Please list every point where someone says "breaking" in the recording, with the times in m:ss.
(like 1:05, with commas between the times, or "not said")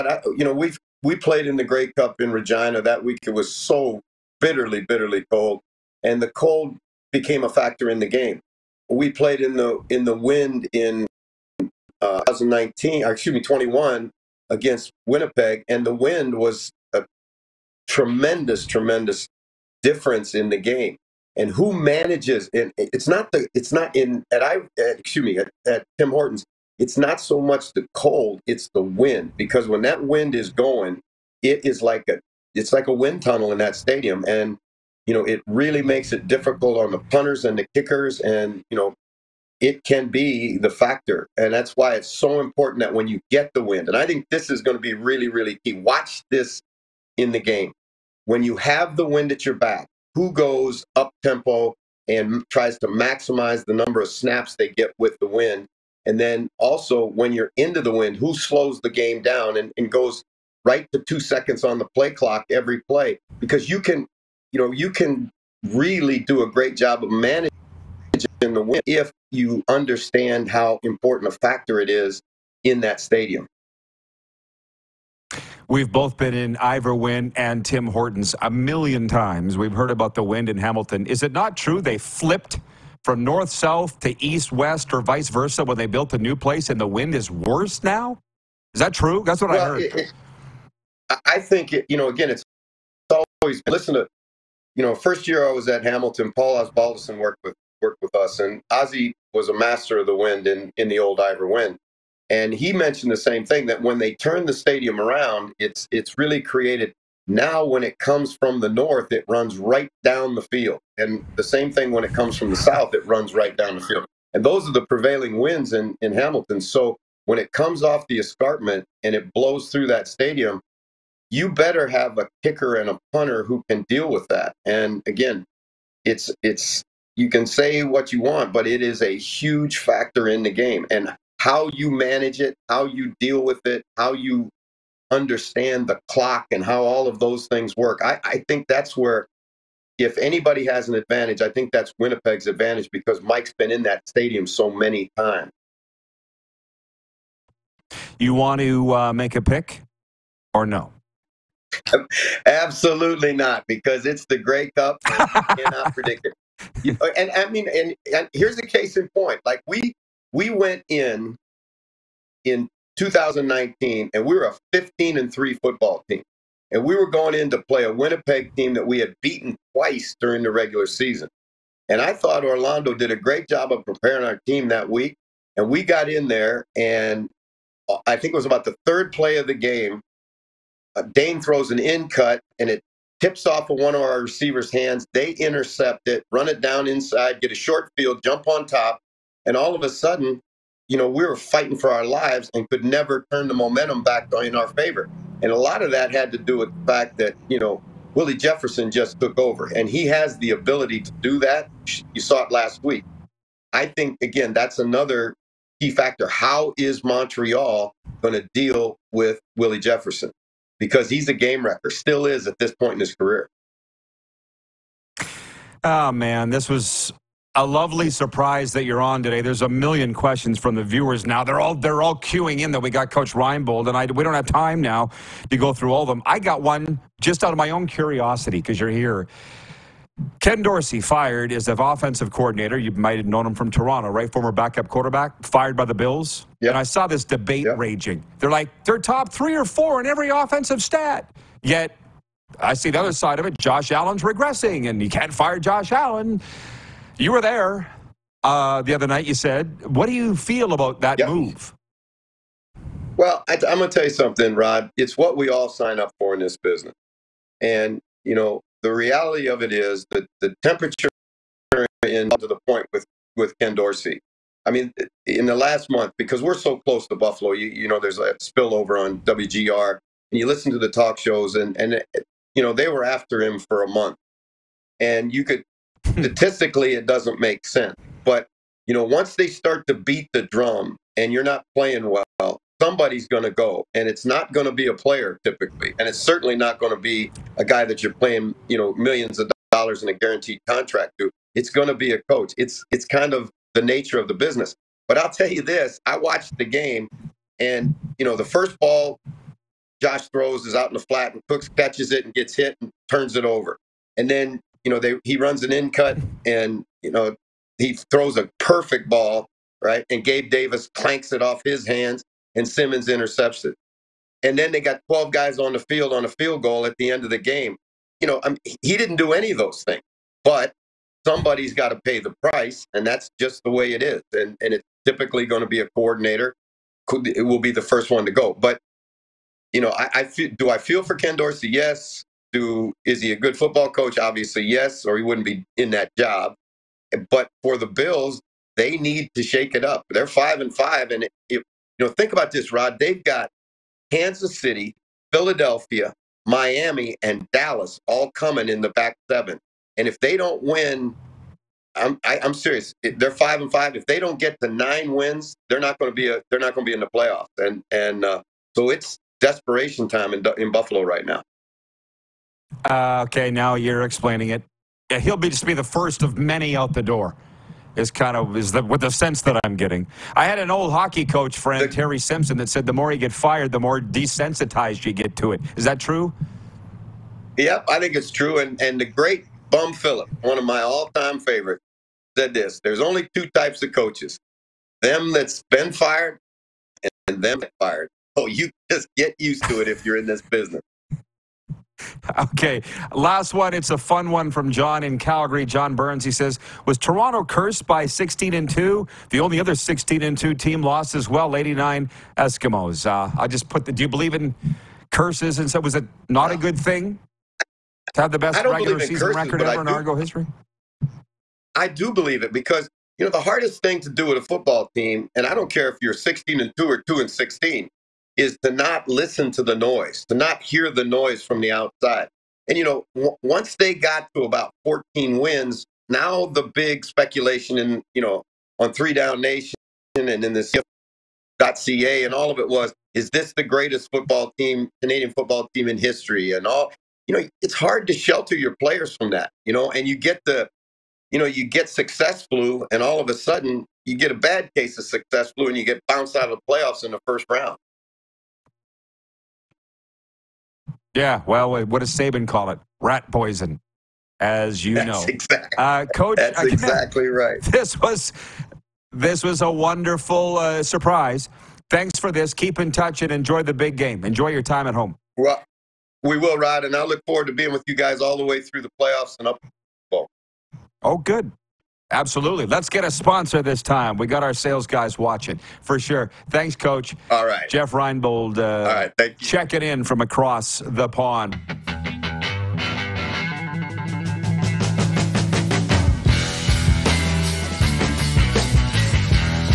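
not said.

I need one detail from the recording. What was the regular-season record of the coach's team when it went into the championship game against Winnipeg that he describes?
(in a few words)
15 and 3.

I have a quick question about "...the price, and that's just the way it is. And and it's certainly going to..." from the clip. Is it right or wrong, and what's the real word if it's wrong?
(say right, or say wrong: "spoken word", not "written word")
wrong: "typically", not "certainly".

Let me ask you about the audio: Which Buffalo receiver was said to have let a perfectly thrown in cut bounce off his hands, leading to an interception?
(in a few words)
Gabe Davis.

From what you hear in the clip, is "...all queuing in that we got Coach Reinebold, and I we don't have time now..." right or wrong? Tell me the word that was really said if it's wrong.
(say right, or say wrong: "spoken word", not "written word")
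right.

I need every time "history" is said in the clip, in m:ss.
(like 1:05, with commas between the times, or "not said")
6:50, 7:15.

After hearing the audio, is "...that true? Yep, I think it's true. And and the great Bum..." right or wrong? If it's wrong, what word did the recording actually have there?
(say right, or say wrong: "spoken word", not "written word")
right.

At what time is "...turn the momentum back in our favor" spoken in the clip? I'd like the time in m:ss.
3:13.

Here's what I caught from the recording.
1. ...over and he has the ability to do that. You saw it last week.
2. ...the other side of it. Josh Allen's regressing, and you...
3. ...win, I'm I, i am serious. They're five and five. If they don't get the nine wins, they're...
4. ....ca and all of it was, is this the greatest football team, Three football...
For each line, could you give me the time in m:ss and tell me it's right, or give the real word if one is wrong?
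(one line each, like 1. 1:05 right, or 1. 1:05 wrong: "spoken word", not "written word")
1. 3:19 right
2. 4:02 right
3. 5:50 right
4. 7:11 wrong: "Canadian", not "Three".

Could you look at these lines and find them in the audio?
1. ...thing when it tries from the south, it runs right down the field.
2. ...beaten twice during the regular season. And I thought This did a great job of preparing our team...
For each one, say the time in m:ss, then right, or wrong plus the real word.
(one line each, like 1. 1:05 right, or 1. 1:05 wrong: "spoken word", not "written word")
1. 1:51 wrong: "comes", not "tries"
2. 2:49 wrong: "Orlando", not "This".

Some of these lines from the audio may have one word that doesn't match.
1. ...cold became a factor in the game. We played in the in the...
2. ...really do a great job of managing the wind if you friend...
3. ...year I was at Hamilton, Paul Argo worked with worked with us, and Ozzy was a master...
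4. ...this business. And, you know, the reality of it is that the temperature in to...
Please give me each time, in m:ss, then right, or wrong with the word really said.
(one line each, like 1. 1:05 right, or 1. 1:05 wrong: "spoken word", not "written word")
1. 0:06 right
2. 1:05 wrong: "understand", not "friend"
3. 1:35 wrong: "Osbaldiston", not "Argo"
4. 4:16 right.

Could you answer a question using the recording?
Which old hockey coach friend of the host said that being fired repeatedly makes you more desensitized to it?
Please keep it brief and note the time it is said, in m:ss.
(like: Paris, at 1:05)
Terry Simpson, at 6:11.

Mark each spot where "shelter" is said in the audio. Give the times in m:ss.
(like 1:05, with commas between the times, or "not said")
7:18.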